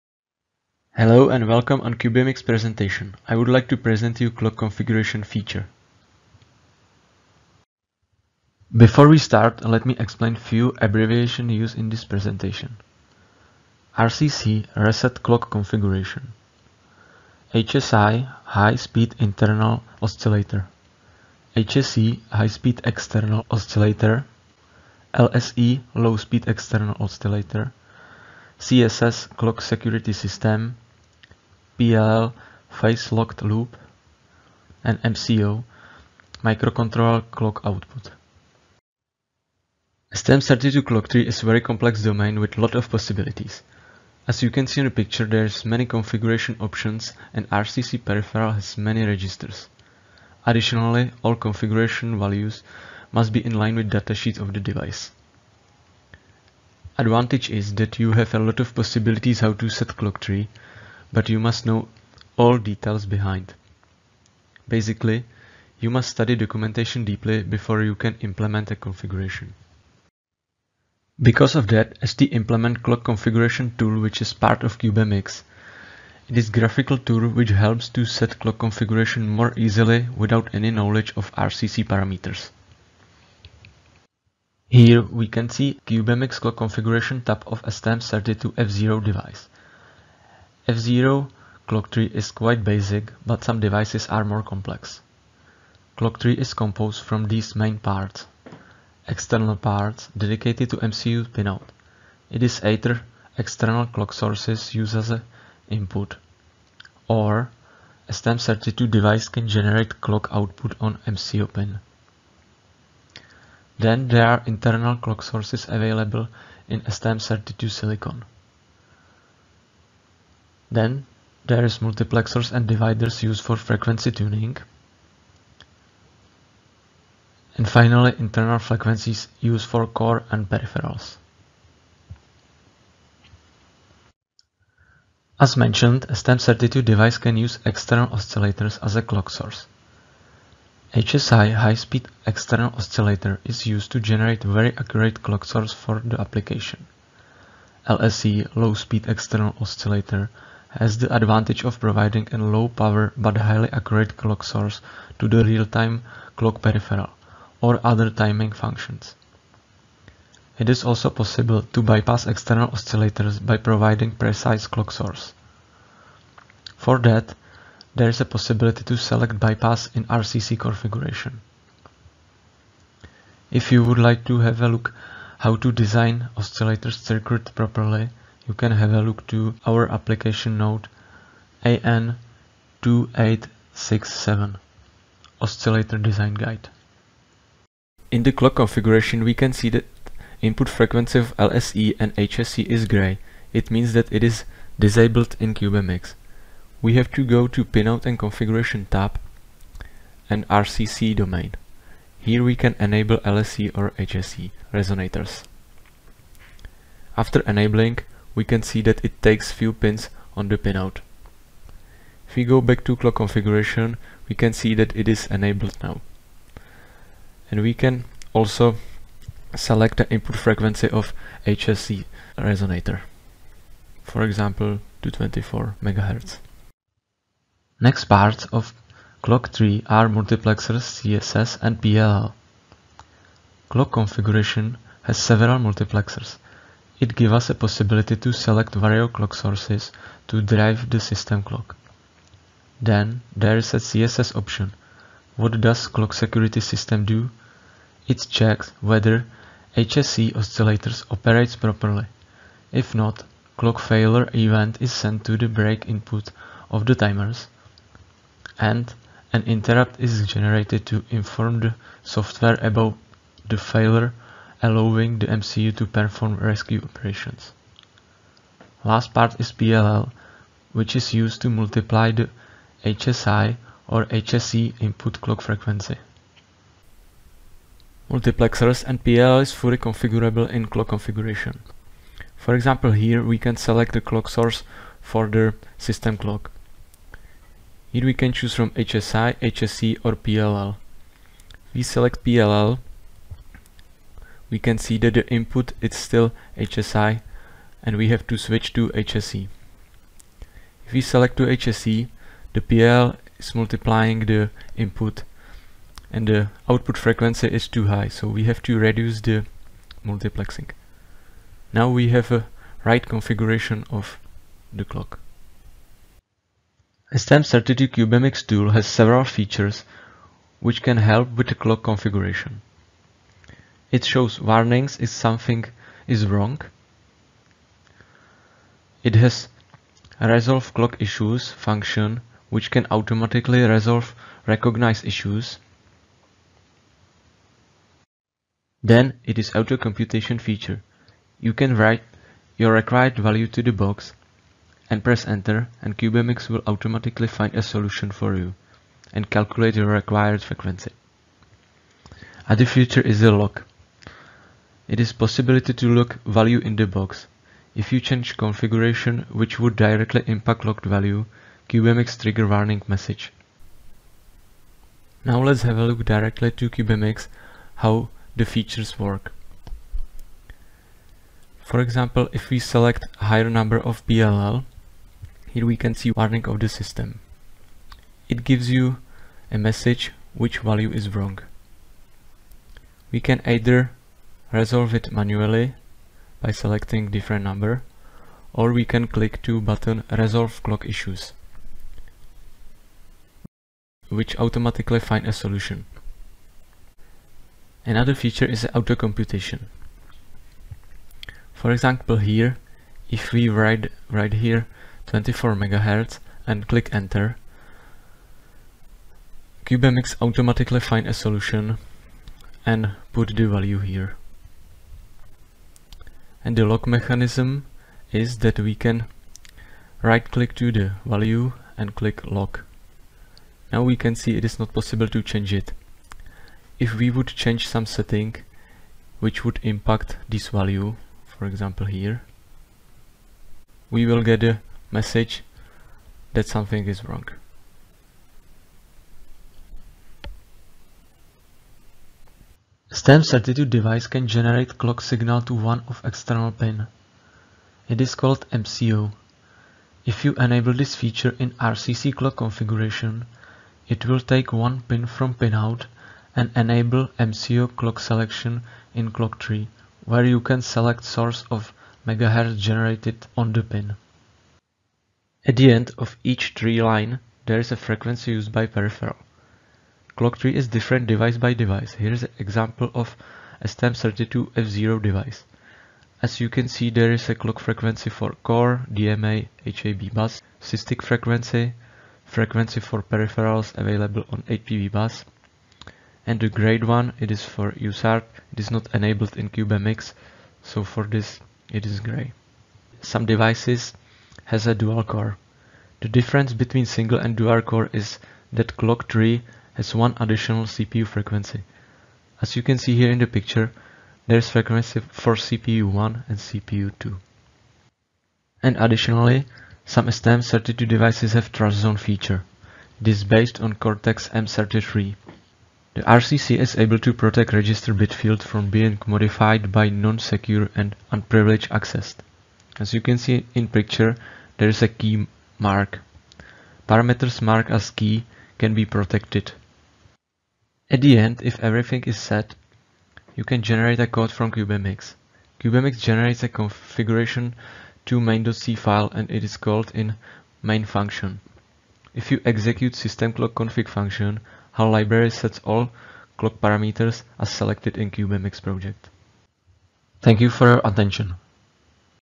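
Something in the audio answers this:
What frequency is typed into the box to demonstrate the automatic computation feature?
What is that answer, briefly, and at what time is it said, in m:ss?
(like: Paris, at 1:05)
24 MHz, at 6:45.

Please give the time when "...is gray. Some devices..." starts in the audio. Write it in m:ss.
8:11.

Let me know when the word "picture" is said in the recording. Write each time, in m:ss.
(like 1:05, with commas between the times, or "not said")
0:44, 8:23, 8:43.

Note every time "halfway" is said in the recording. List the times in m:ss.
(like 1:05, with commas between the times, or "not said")
not said.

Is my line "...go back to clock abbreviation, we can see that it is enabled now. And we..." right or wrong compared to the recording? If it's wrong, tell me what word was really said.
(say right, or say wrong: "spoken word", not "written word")
wrong: "configuration", not "abbreviation".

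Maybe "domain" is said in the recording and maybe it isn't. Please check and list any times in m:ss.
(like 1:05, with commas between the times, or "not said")
0:42, 3:21.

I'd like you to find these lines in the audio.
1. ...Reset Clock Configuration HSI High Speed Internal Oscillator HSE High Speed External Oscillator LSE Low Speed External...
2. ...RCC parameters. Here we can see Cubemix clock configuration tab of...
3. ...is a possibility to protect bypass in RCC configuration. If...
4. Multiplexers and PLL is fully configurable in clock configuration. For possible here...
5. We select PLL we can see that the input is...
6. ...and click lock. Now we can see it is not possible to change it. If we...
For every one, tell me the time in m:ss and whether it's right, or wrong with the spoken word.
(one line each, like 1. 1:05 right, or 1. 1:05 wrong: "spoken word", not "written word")
1. 0:14 right
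2. 1:21 right
3. 2:48 wrong: "select", not "protect"
4. 4:38 wrong: "example", not "possible"
5. 4:51 right
6. 7:01 right.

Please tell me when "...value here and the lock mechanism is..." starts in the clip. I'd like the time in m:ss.
6:53.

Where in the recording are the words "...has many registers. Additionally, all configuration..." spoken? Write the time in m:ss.
0:48.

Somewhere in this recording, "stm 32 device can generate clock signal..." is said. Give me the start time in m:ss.
7:23.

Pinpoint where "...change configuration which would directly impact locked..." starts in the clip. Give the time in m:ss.
5:58.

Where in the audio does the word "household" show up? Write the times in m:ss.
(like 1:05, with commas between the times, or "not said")
not said.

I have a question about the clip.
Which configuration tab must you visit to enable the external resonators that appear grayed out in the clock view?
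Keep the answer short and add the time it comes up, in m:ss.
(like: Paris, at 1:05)
Pinout and Configuration, at 3:17.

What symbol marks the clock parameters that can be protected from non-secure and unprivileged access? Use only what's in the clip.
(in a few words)
key mark.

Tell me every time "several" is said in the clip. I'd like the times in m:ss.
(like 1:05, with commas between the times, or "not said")
3:55, 5:18.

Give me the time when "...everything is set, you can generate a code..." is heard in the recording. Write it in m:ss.
8:51.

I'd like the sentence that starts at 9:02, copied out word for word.
If you execute system clock config function, our library sets all clock parameters as selected in Cubemix project.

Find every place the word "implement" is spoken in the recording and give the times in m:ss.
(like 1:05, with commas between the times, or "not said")
1:08, 1:12.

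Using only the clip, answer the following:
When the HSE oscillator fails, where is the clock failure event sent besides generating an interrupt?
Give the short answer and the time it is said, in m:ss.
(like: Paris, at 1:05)
break input of the timers, at 4:15.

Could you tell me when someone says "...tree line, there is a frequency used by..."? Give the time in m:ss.
7:46.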